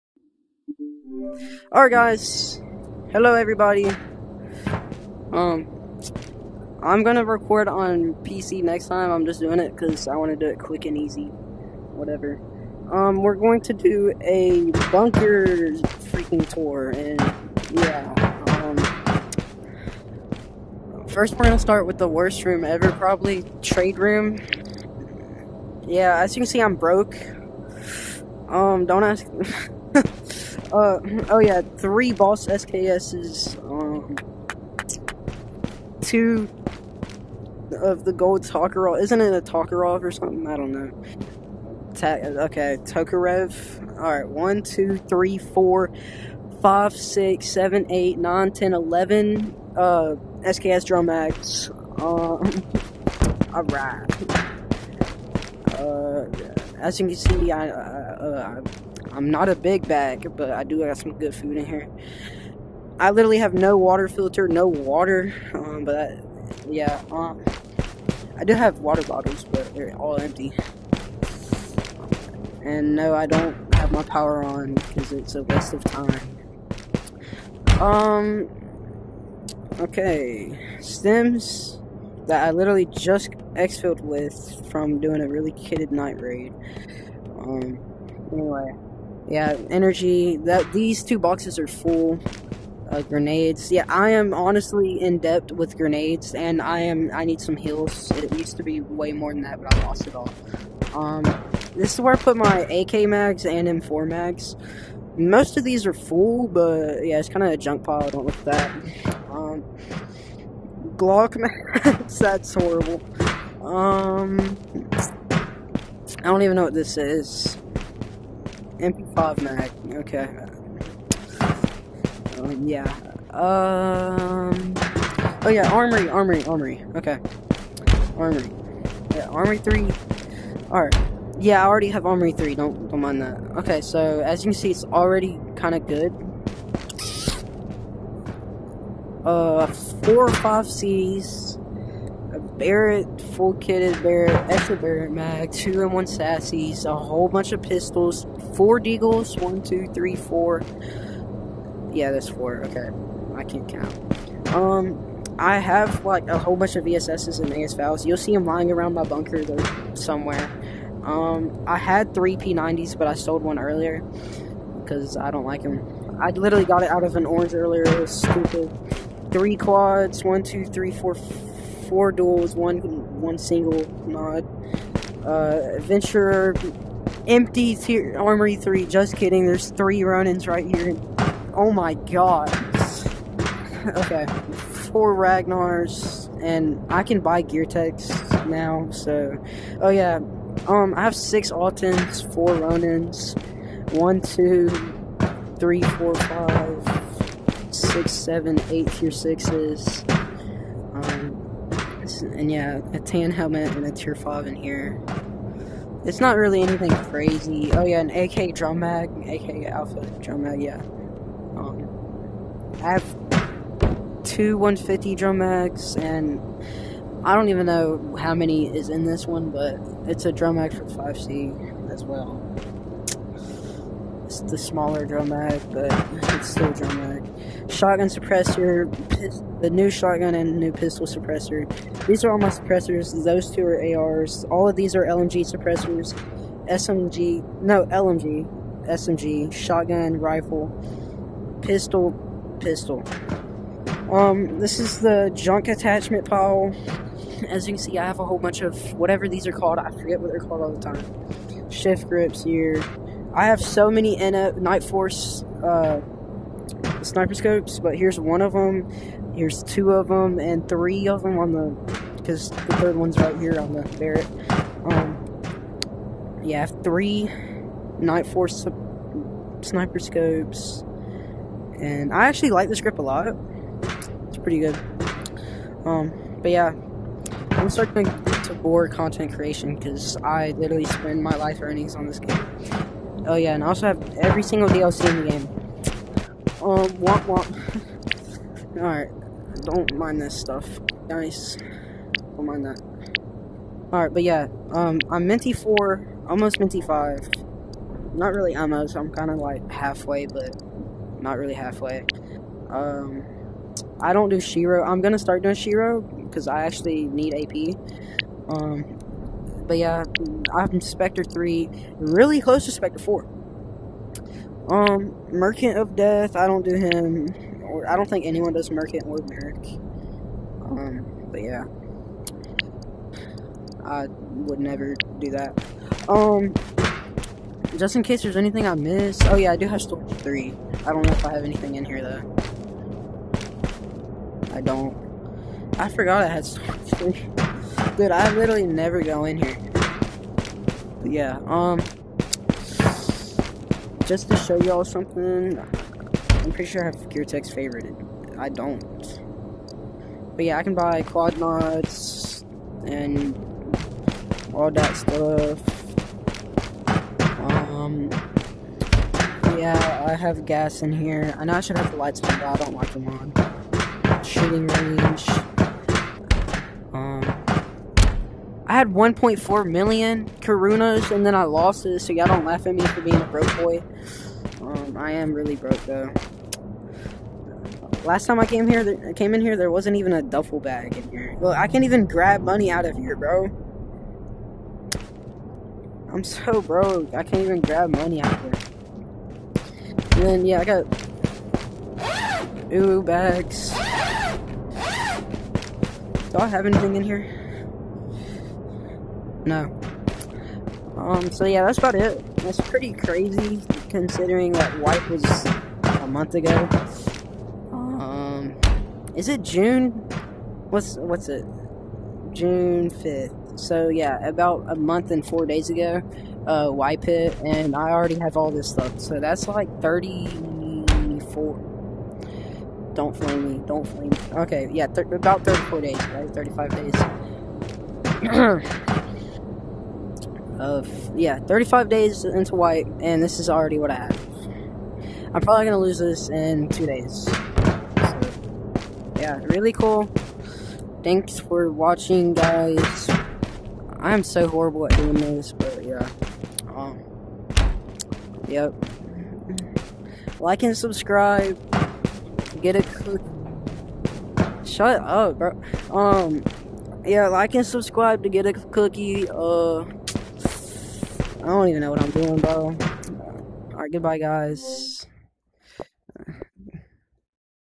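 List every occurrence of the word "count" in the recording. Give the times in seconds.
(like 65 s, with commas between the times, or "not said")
153 s.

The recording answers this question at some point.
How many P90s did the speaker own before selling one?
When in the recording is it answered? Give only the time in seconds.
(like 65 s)
161 s.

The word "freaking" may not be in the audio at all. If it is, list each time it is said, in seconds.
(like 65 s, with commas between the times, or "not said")
16 s.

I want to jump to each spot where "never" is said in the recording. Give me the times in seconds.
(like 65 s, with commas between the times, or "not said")
324 s, 338 s.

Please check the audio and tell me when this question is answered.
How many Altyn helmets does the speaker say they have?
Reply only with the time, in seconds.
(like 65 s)
191 s.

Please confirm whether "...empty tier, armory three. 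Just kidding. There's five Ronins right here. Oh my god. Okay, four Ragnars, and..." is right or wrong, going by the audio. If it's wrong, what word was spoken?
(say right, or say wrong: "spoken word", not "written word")
wrong: "three", not "five".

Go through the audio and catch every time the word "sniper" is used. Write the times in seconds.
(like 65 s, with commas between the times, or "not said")
257 s, 269 s.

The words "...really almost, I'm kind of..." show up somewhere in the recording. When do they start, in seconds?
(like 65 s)
298 s.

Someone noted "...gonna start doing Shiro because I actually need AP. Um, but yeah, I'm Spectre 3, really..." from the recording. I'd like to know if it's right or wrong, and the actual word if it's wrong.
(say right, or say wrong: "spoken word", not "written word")
right.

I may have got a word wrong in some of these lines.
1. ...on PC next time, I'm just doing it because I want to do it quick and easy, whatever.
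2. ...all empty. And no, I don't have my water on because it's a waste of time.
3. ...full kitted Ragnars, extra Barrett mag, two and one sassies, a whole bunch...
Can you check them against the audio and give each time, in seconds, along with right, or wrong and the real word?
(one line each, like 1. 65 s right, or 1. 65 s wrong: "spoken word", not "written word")
1. 7 s right
2. 69 s wrong: "power", not "water"
3. 143 s wrong: "Barrett", not "Ragnars".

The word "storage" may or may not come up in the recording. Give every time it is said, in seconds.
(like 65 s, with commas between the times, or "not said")
329 s, 336 s.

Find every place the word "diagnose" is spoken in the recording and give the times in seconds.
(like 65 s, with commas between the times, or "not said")
not said.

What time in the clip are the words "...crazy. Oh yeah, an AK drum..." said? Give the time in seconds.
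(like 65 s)
207 s.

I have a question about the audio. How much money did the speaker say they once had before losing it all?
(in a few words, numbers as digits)
1.4 million Karunas.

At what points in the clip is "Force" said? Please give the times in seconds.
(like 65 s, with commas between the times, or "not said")
254 s, 268 s.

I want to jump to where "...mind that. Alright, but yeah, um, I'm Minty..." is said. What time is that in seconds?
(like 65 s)
292 s.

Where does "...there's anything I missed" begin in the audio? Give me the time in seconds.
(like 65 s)
328 s.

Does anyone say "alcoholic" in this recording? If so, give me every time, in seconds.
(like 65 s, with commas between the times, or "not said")
not said.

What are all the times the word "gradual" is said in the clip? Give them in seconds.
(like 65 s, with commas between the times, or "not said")
not said.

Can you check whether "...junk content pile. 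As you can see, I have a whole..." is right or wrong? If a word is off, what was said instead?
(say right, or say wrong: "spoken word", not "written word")
wrong: "attachment", not "content".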